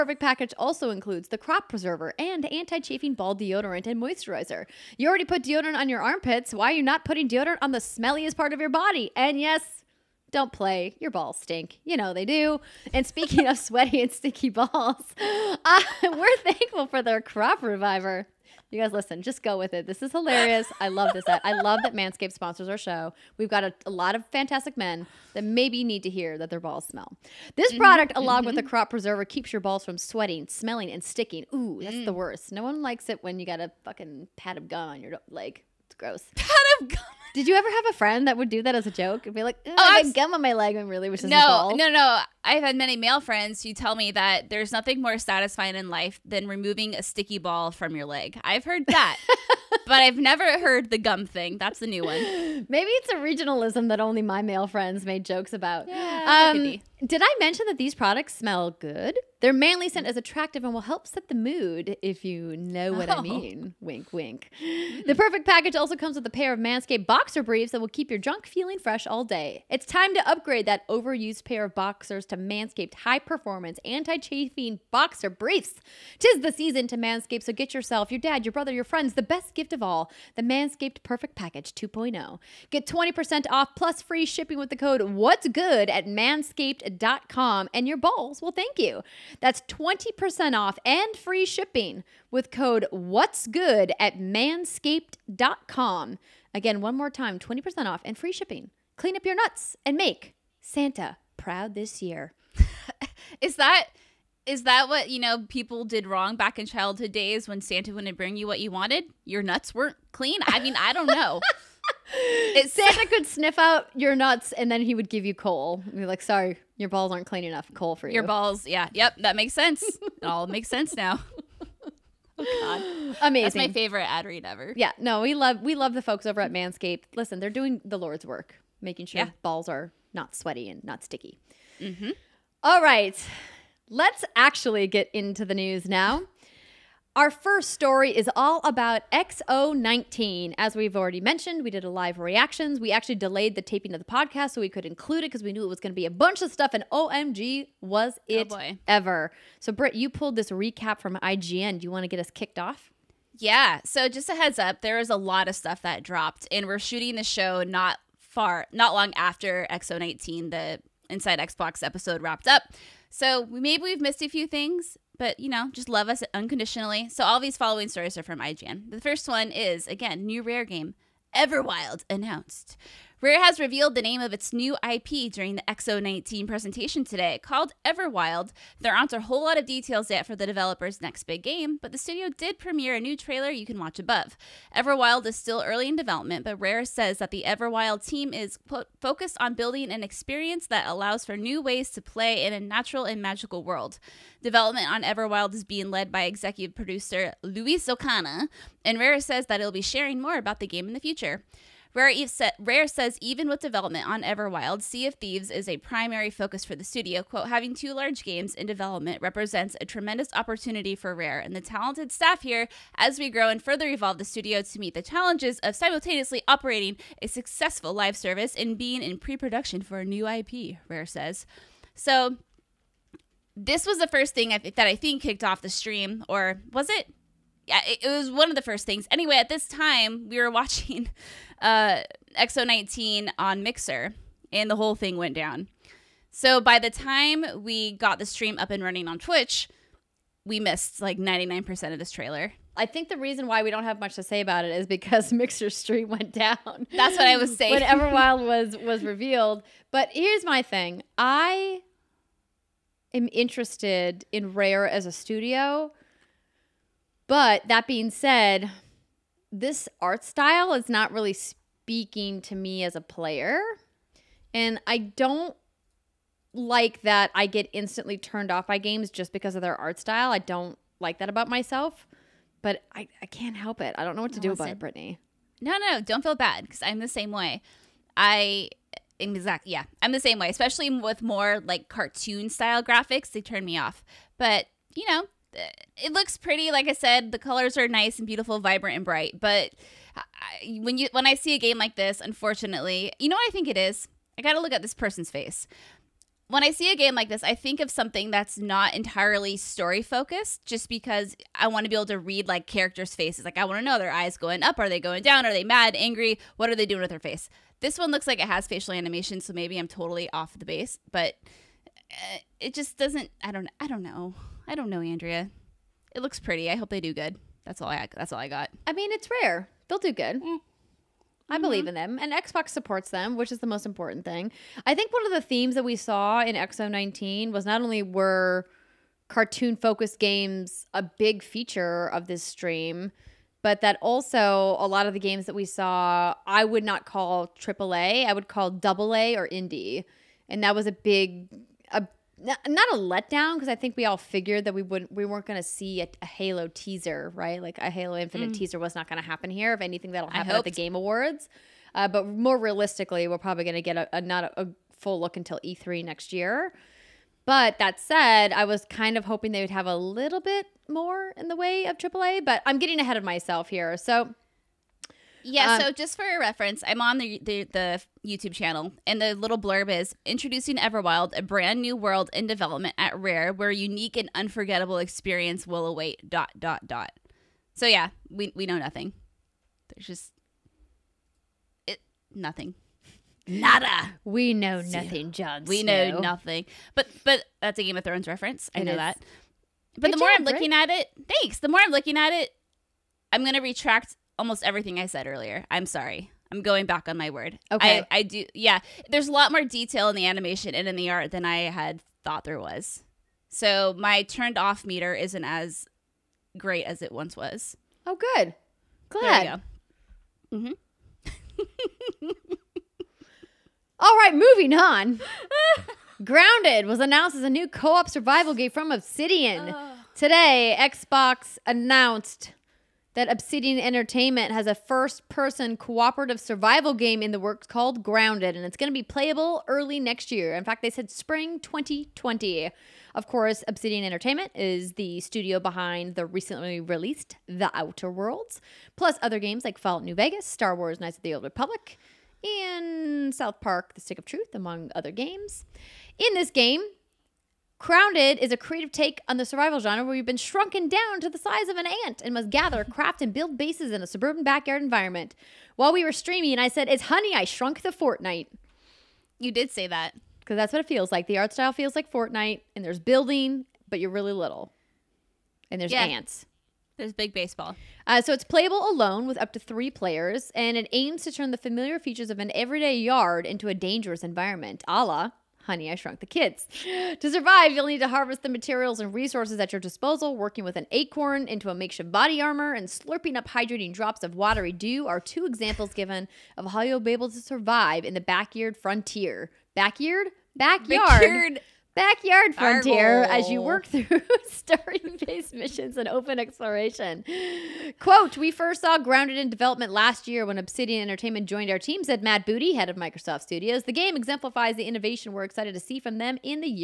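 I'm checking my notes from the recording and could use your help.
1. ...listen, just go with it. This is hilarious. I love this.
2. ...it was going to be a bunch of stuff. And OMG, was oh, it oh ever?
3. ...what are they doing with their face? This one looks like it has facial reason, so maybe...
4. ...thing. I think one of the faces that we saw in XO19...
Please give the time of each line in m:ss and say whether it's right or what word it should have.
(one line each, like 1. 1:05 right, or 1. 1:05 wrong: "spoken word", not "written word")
1. 0:18 right
2. 2:25 right
3. 5:06 wrong: "animation", not "reason"
4. 5:24 wrong: "themes", not "faces".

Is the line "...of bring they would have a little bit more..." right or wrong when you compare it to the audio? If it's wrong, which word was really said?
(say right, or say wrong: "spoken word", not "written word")
wrong: "hoping", not "bring".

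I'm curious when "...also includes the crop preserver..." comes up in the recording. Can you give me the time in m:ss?
0:00.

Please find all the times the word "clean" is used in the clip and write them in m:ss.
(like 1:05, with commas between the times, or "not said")
1:38, 1:50, 1:57.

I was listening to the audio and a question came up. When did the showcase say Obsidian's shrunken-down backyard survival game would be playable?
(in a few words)
Spring 2020.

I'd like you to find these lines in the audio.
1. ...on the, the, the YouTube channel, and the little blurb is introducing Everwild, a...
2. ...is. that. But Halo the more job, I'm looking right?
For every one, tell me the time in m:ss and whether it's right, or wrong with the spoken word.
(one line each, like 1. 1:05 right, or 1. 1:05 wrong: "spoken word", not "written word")
1. 6:07 right
2. 6:28 wrong: "Good", not "Halo".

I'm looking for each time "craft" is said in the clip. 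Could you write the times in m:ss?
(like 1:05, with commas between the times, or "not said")
7:32.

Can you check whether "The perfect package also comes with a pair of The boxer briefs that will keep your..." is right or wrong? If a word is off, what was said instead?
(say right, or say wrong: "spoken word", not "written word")
wrong: "Manscaped", not "The".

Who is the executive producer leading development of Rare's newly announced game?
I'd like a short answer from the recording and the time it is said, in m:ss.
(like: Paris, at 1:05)
Louise O'Connor, at 3:17.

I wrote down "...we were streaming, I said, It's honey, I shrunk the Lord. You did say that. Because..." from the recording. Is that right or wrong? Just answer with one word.
wrong.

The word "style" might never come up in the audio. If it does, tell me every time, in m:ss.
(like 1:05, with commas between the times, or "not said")
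4:20, 4:29, 4:42, 7:41.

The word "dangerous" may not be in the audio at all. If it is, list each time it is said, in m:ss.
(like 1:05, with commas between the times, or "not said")
7:53.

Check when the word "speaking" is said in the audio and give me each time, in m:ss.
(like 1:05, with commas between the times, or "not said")
0:13, 4:21.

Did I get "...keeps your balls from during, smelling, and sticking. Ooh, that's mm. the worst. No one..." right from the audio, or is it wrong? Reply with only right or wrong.
wrong.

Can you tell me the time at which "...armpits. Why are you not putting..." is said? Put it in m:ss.
0:06.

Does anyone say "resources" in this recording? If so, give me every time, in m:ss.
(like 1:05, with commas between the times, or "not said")
7:59.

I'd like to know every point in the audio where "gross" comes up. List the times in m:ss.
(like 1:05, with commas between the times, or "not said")
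0:35.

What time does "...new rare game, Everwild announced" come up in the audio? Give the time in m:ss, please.
2:50.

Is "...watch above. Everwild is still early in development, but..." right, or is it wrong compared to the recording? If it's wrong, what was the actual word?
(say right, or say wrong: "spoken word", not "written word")
right.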